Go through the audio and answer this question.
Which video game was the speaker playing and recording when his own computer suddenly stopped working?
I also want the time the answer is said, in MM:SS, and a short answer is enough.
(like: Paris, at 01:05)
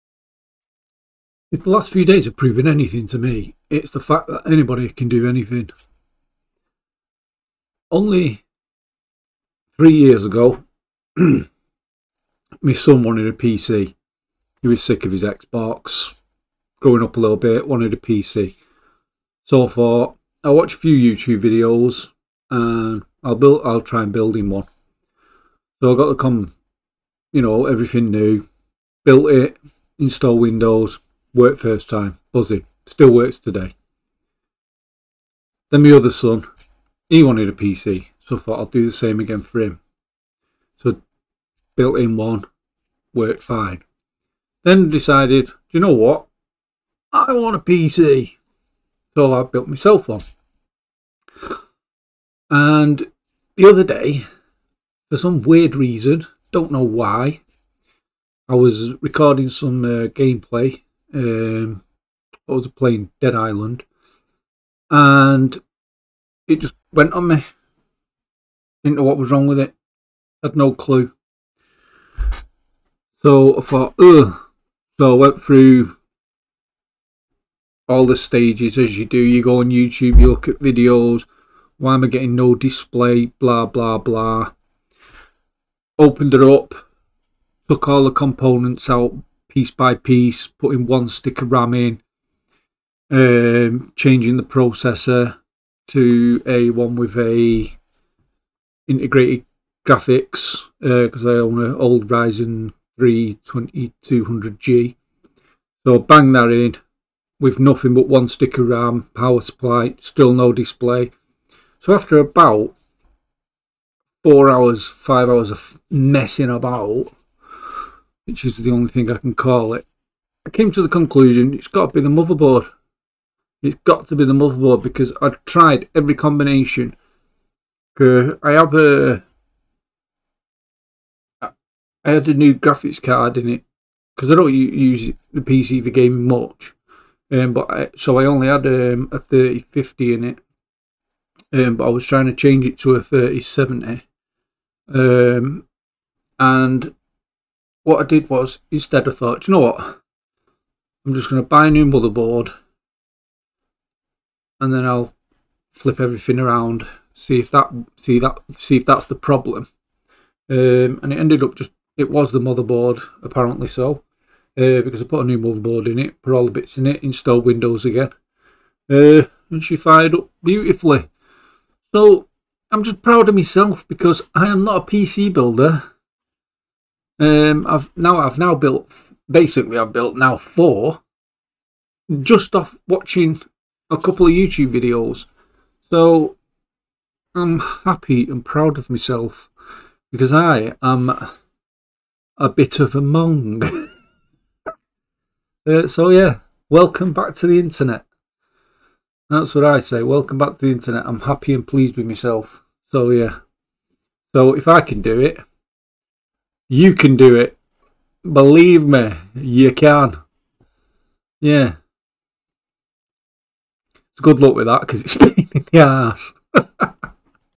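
Dead Island, at 01:03.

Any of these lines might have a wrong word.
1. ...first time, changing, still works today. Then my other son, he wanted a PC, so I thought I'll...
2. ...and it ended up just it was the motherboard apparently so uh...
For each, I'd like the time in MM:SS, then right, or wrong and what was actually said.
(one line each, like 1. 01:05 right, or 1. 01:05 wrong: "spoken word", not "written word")
1. 00:31 wrong: "buzzing", not "changing"
2. 02:41 right.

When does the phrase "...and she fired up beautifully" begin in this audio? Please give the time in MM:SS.
02:49.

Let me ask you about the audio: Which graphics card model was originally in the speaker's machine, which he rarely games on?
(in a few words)
3050.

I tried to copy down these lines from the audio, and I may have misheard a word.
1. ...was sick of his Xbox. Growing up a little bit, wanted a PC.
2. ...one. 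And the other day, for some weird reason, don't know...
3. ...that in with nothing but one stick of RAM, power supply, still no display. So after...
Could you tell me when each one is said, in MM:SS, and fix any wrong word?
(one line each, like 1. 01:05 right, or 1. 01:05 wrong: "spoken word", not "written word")
1. 00:14 right
2. 00:50 right
3. 01:46 right.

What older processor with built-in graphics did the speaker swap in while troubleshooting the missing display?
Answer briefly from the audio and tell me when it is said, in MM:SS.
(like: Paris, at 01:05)
Ryzen 3 2200G, at 01:42.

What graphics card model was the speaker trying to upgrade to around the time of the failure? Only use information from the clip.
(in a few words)
3070.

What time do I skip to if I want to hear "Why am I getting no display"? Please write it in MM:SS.
01:21.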